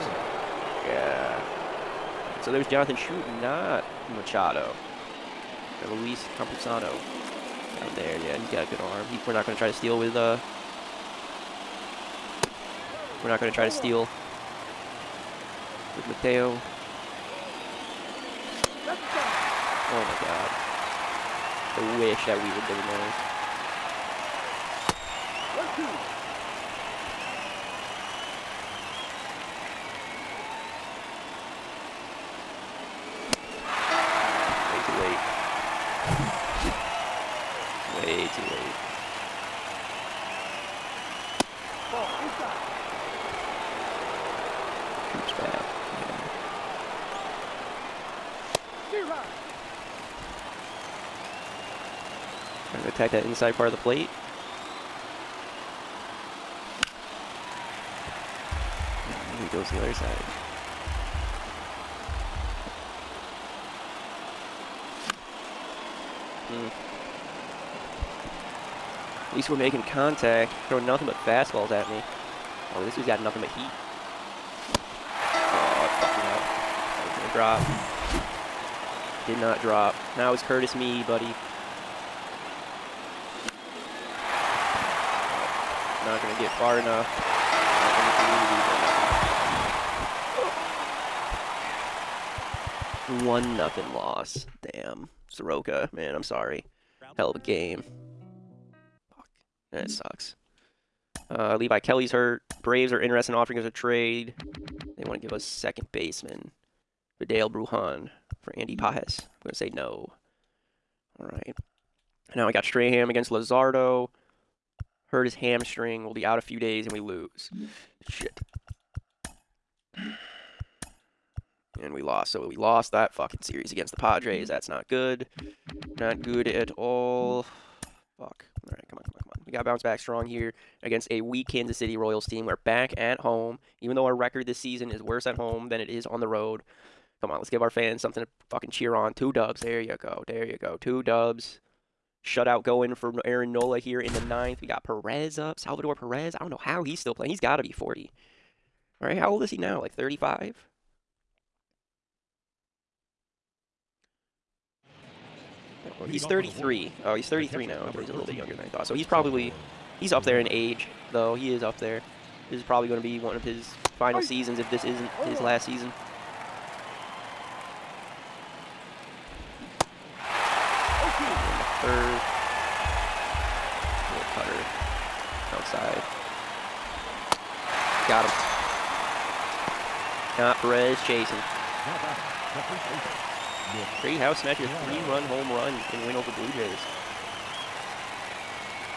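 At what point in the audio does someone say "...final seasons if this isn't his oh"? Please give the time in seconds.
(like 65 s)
163 s.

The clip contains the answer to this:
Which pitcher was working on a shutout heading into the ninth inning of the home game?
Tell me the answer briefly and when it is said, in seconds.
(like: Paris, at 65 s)
Aaron Nola, at 143 s.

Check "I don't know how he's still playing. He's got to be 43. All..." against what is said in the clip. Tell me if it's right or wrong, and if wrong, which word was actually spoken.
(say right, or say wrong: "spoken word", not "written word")
wrong: "40", not "43".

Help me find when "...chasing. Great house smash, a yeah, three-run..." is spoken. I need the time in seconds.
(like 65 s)
181 s.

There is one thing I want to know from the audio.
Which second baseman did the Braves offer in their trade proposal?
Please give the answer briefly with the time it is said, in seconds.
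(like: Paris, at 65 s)
Vidal Bruján, at 107 s.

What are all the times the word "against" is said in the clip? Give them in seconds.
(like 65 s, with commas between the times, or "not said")
113 s, 123 s, 130 s.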